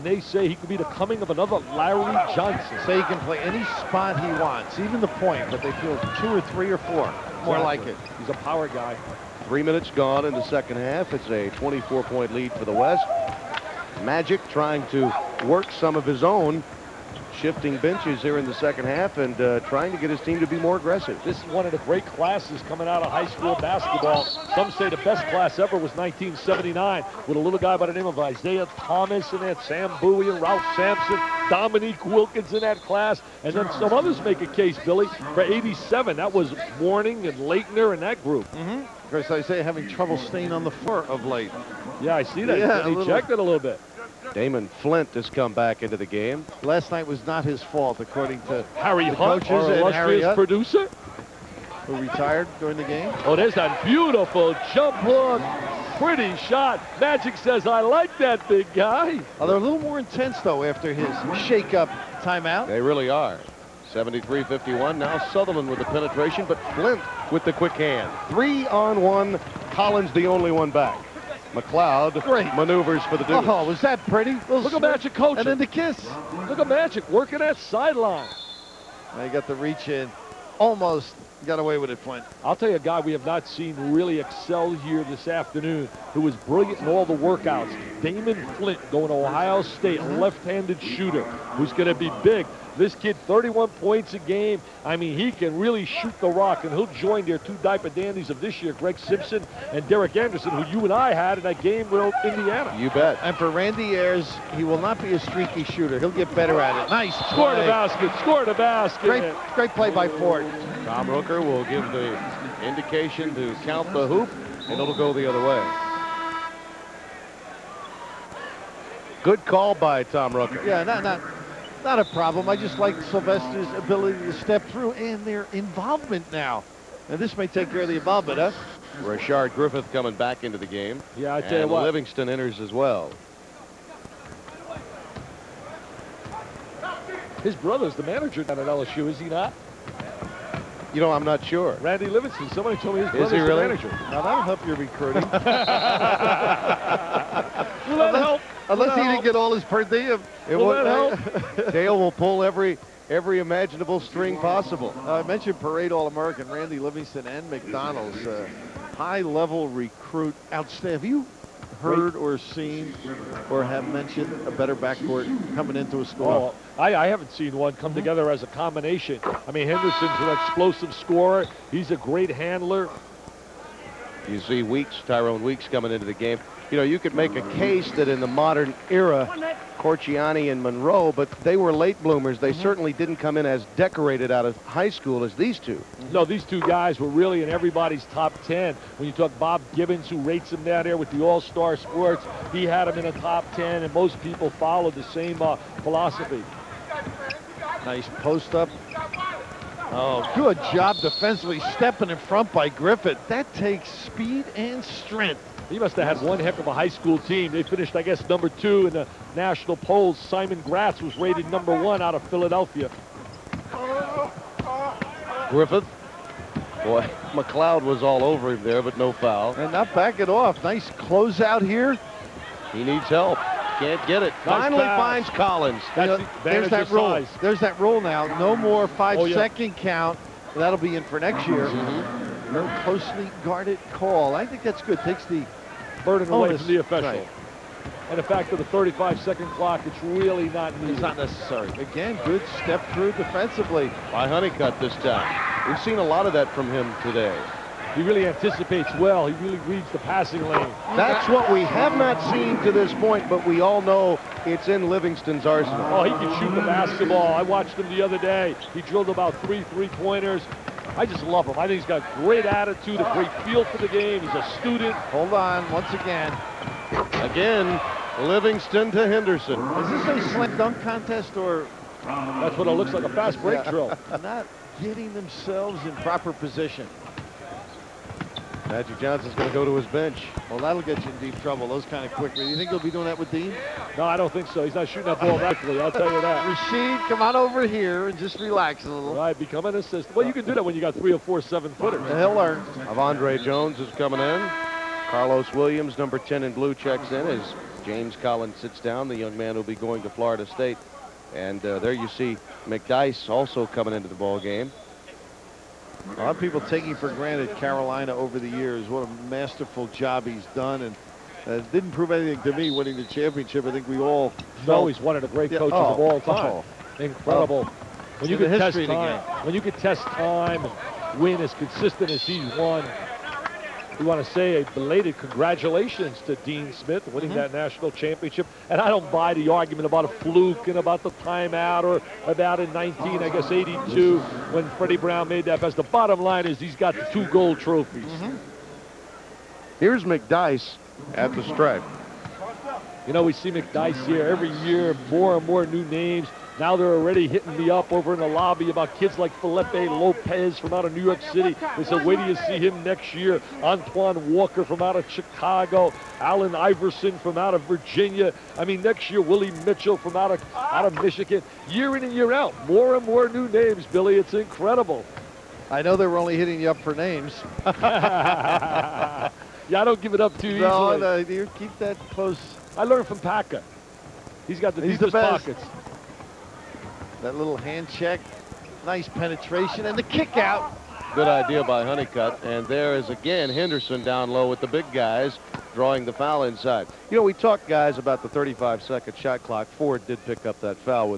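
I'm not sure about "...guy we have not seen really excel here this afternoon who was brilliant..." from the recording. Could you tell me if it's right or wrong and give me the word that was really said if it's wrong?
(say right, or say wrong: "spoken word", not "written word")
right.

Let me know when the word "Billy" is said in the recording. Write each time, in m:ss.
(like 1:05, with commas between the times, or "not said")
0:34, 6:03.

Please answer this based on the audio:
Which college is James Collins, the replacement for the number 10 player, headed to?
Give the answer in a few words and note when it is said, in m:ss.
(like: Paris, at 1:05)
Florida State, at 5:00.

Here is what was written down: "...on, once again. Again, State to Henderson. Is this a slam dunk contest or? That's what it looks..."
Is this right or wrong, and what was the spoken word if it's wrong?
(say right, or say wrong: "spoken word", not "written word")
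wrong: "Livingston", not "State".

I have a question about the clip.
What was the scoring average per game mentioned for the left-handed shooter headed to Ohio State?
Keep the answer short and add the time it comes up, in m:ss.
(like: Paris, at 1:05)
31 points, at 1:33.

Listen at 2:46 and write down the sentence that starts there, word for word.
Oh, I, I, haven't seen one come together as a combination.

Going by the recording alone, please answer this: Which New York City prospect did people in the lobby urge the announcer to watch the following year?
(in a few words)
Felipe Lopez.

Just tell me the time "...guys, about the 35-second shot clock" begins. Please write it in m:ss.
6:27.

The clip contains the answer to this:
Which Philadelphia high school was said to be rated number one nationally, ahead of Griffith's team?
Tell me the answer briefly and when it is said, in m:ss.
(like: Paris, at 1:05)
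Simon Gratz, at 3:30.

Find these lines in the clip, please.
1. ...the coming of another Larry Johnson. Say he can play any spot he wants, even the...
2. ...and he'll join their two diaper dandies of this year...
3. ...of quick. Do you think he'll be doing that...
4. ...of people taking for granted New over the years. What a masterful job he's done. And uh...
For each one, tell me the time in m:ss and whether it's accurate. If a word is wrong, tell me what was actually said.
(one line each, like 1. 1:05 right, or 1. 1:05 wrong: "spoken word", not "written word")
1. 0:00 right
2. 1:36 right
3. 4:42 right
4. 5:06 wrong: "Carolina", not "New".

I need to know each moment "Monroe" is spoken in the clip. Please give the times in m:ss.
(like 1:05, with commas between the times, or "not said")
3:00.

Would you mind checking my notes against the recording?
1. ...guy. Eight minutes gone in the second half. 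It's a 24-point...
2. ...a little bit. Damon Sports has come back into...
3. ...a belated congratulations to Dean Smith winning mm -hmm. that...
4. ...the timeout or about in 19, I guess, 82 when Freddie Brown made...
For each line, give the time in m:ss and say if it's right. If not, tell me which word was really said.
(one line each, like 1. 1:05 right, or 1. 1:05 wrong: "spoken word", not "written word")
1. 0:08 wrong: "Three", not "Eight"
2. 0:43 wrong: "Flint", not "Sports"
3. 5:24 right
4. 5:31 right.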